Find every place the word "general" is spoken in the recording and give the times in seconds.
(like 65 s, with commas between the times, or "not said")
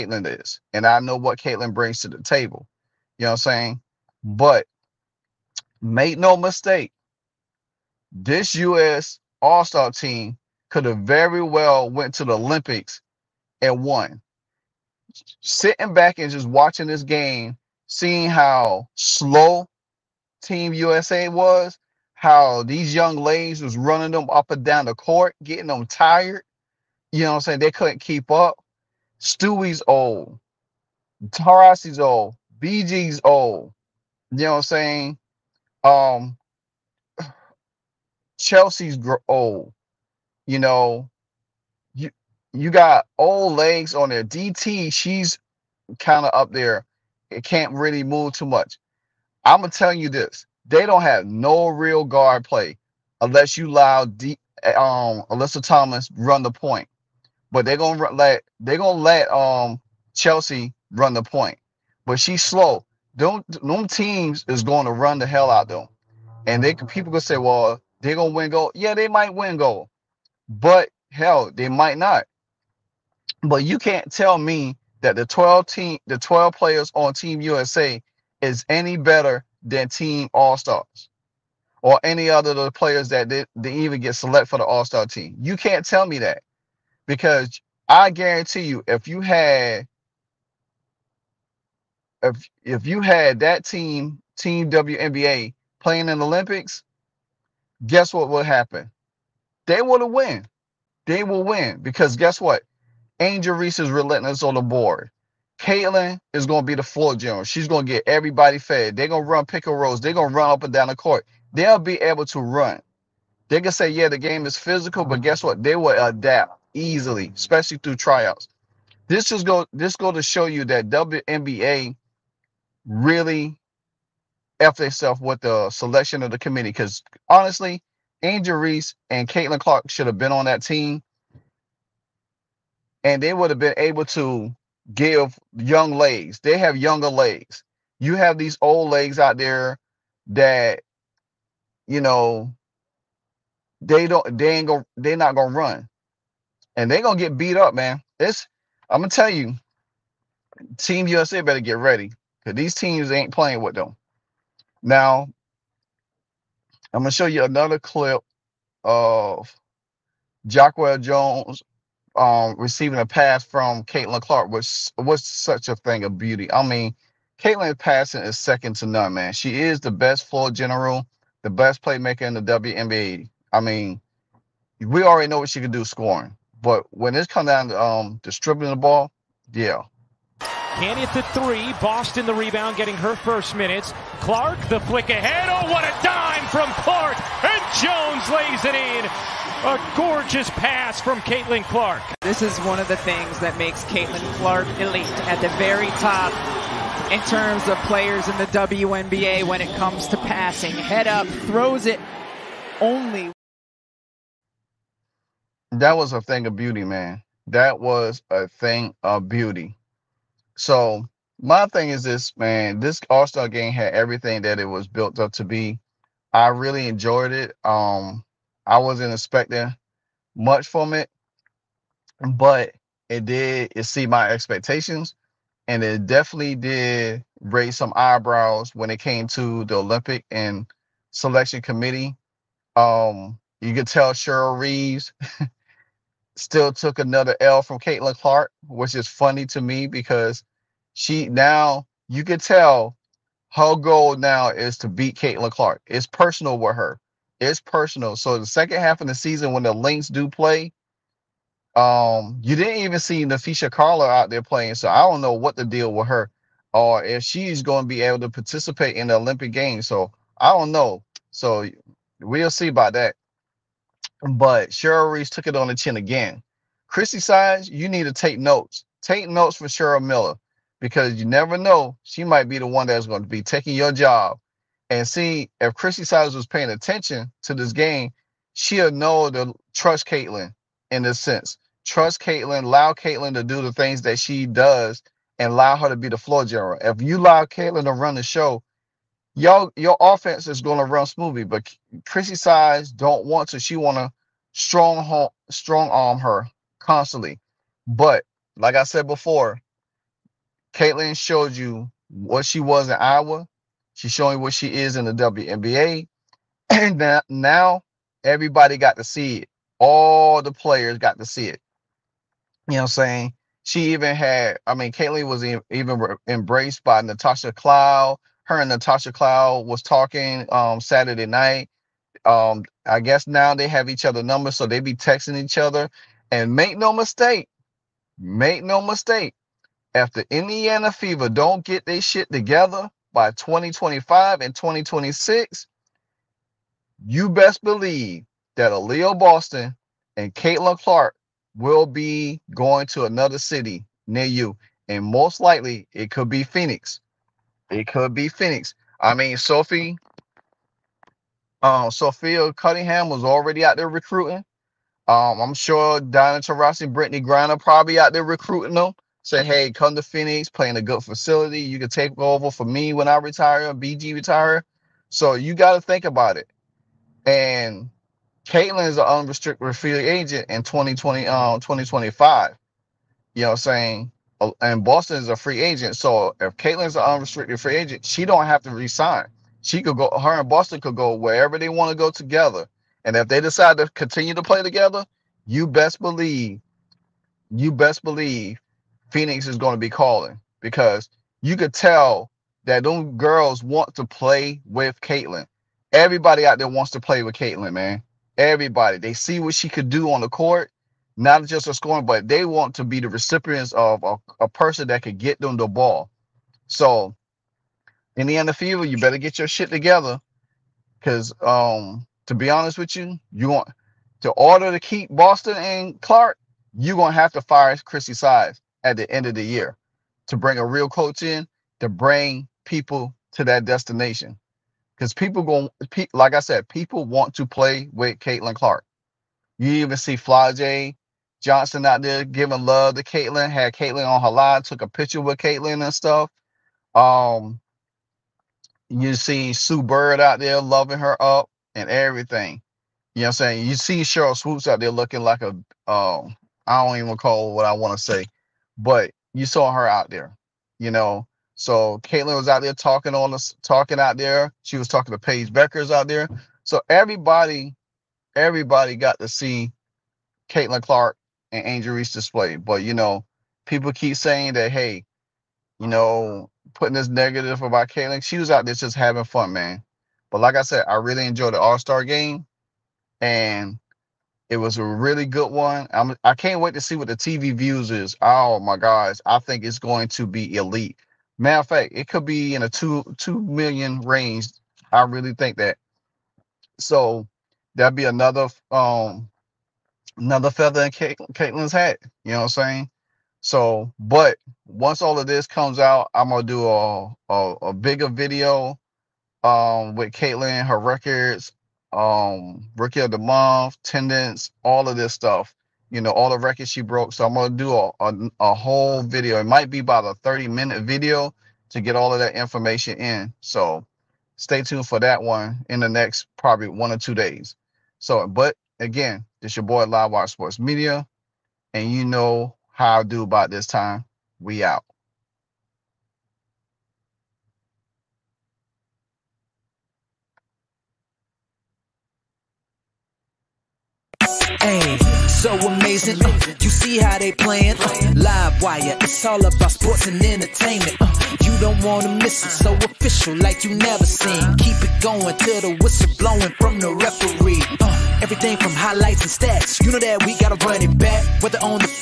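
107 s, 170 s, 286 s.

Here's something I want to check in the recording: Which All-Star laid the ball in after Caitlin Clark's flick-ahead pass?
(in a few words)
Jonquel Jones.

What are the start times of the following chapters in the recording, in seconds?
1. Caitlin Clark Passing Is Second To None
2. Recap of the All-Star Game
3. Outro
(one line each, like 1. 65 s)
1. 160 s
2. 211 s
3. 497 s.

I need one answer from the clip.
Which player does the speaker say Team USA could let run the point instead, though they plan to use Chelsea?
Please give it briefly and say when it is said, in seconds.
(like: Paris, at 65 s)
Alyssa Thomas, at 55 s.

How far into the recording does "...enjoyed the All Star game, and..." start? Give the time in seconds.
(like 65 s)
471 s.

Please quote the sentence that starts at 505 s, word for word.
You know, all the records she broke.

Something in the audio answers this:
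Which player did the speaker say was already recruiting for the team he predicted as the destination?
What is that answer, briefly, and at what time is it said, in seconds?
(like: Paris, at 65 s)
Sophia Cunningham, at 351 s.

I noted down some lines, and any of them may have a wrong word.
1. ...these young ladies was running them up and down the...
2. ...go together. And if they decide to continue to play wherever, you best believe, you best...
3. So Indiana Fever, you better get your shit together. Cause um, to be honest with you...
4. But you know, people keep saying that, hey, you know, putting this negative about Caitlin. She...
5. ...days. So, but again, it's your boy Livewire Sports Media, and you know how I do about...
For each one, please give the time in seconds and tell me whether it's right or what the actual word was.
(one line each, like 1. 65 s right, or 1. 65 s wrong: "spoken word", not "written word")
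1. 22 s right
2. 381 s wrong: "together", not "wherever"
3. 406 s right
4. 462 s right
5. 517 s right.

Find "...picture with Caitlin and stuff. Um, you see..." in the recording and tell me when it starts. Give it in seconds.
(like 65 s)
434 s.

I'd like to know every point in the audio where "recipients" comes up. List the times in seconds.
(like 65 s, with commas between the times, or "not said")
403 s.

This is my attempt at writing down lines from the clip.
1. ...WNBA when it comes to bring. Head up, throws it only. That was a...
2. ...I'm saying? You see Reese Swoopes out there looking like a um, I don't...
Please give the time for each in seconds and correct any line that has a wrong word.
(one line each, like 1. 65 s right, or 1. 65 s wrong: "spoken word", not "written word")
1. 198 s wrong: "passing", not "bring"
2. 443 s wrong: "Sheryl", not "Reese".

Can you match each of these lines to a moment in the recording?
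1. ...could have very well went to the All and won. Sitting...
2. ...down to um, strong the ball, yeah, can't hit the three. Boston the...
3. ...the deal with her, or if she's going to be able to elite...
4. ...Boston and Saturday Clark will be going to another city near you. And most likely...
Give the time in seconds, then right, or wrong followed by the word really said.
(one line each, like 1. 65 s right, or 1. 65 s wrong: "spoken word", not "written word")
1. 10 s wrong: "Olympics", not "All"
2. 177 s wrong: "distributing", not "strong"
3. 255 s wrong: "participate", not "elite"
4. 339 s wrong: "Caitlin", not "Saturday".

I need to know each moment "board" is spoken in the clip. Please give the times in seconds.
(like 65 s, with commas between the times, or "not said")
104 s.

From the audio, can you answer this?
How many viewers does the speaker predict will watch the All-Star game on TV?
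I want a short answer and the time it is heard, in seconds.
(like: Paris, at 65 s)
2 million, at 482 s.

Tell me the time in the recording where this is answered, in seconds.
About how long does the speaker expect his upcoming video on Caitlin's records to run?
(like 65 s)
510 s.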